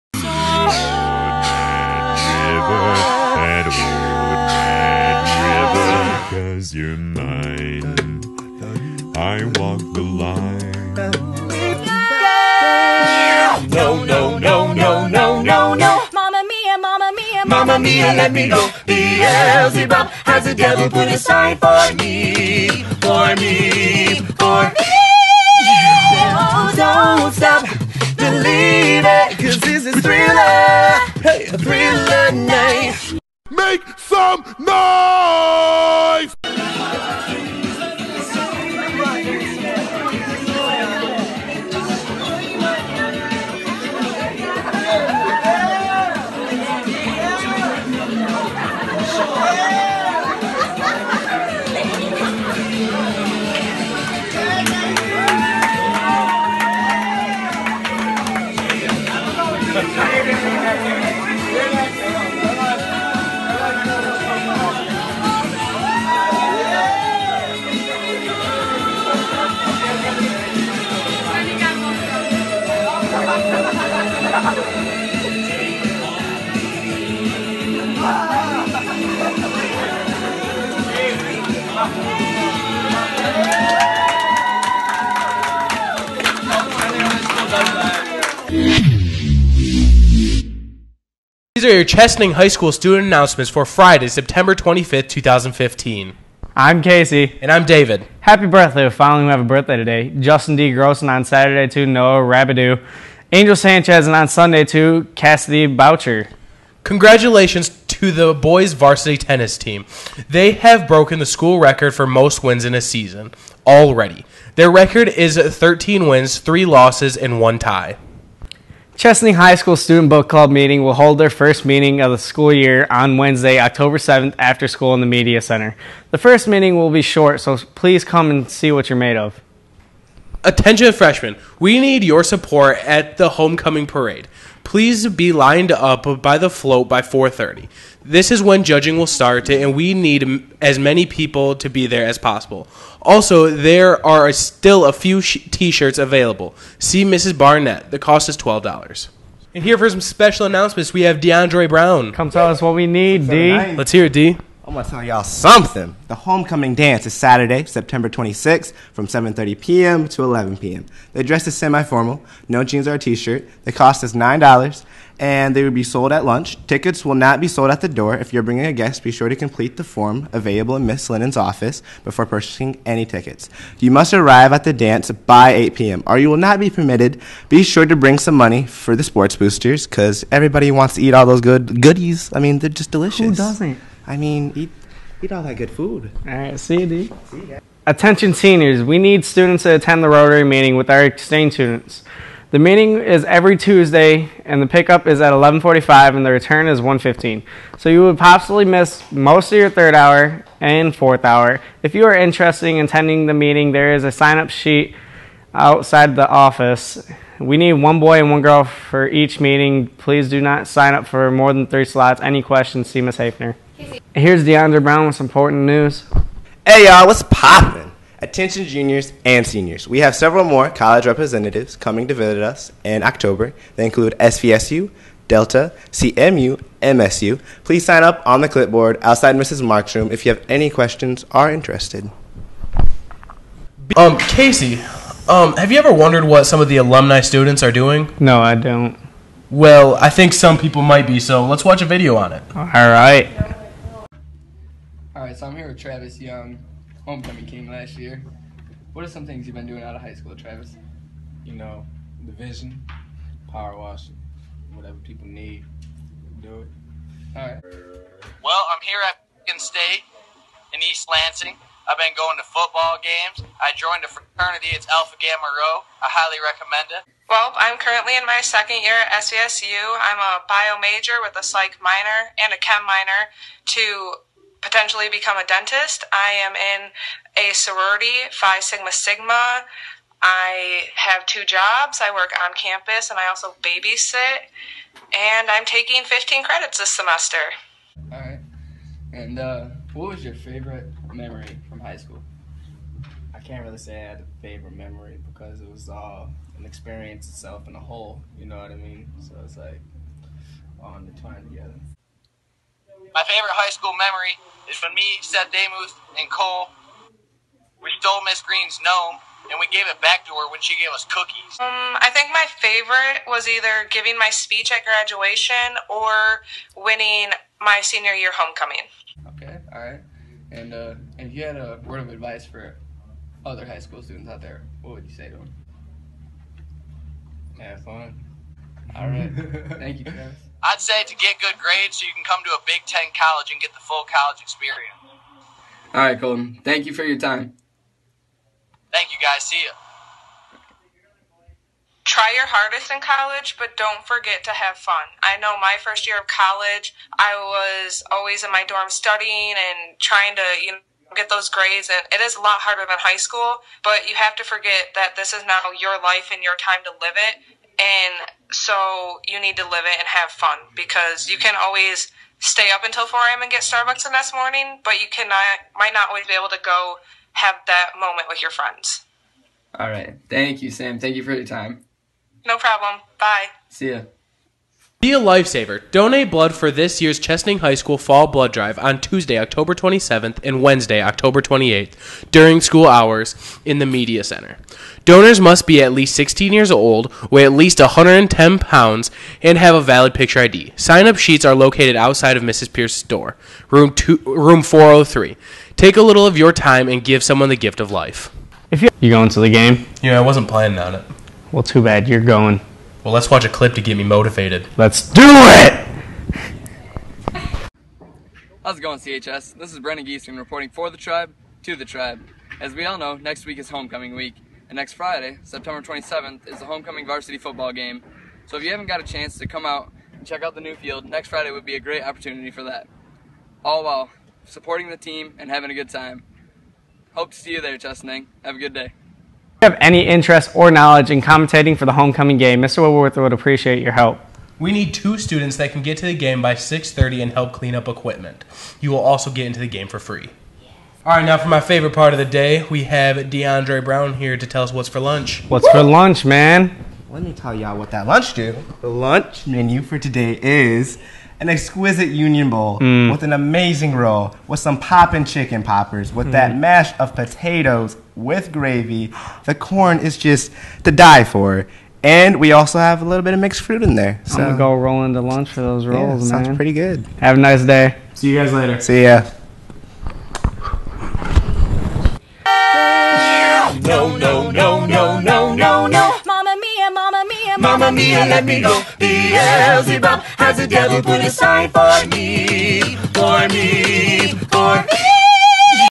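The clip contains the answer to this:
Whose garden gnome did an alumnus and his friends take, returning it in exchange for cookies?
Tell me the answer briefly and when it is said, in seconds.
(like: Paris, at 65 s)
Miss Green, at 308 s.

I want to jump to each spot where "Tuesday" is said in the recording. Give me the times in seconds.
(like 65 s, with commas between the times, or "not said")
193 s, 379 s.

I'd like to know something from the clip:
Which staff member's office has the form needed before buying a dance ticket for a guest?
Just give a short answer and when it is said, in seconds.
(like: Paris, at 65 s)
Miss Lennon, at 170 s.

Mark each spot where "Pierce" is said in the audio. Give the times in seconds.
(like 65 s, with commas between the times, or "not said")
392 s.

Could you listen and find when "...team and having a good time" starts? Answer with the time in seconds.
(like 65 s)
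424 s.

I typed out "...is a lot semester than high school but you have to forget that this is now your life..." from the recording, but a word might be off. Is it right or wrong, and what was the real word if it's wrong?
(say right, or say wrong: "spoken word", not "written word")
wrong: "harder", not "semester".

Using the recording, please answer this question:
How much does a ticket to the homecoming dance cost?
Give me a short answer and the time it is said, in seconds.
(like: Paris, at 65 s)
$9, at 164 s.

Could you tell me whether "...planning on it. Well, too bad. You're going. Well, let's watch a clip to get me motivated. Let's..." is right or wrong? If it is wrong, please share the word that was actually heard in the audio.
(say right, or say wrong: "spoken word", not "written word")
right.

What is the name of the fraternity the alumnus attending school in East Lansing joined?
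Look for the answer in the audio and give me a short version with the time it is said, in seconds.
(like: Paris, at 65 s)
Alpha Gamma Rho, at 264 s.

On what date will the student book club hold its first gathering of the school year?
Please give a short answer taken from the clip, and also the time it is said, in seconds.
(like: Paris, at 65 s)
October 7th, at 123 s.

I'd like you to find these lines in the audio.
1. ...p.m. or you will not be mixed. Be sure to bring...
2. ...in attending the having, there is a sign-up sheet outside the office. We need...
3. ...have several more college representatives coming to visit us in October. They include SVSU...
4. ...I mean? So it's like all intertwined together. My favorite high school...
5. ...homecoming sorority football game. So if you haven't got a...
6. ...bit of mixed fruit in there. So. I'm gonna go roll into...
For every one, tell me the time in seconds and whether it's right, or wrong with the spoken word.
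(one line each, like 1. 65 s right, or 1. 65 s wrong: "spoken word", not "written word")
1. 175 s wrong: "permitted", not "mixed"
2. 202 s wrong: "meeting", not "having"
3. 220 s right
4. 298 s right
5. 416 s wrong: "varsity", not "sorority"
6. 463 s right.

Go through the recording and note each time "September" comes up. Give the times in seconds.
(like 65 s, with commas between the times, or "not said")
94 s, 157 s, 415 s.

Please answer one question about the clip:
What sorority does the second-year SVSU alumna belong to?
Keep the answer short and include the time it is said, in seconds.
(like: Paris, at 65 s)
Phi Sigma Sigma, at 278 s.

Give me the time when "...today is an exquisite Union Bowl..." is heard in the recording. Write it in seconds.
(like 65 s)
449 s.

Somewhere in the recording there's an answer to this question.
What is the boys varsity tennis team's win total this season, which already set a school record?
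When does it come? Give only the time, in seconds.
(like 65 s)
115 s.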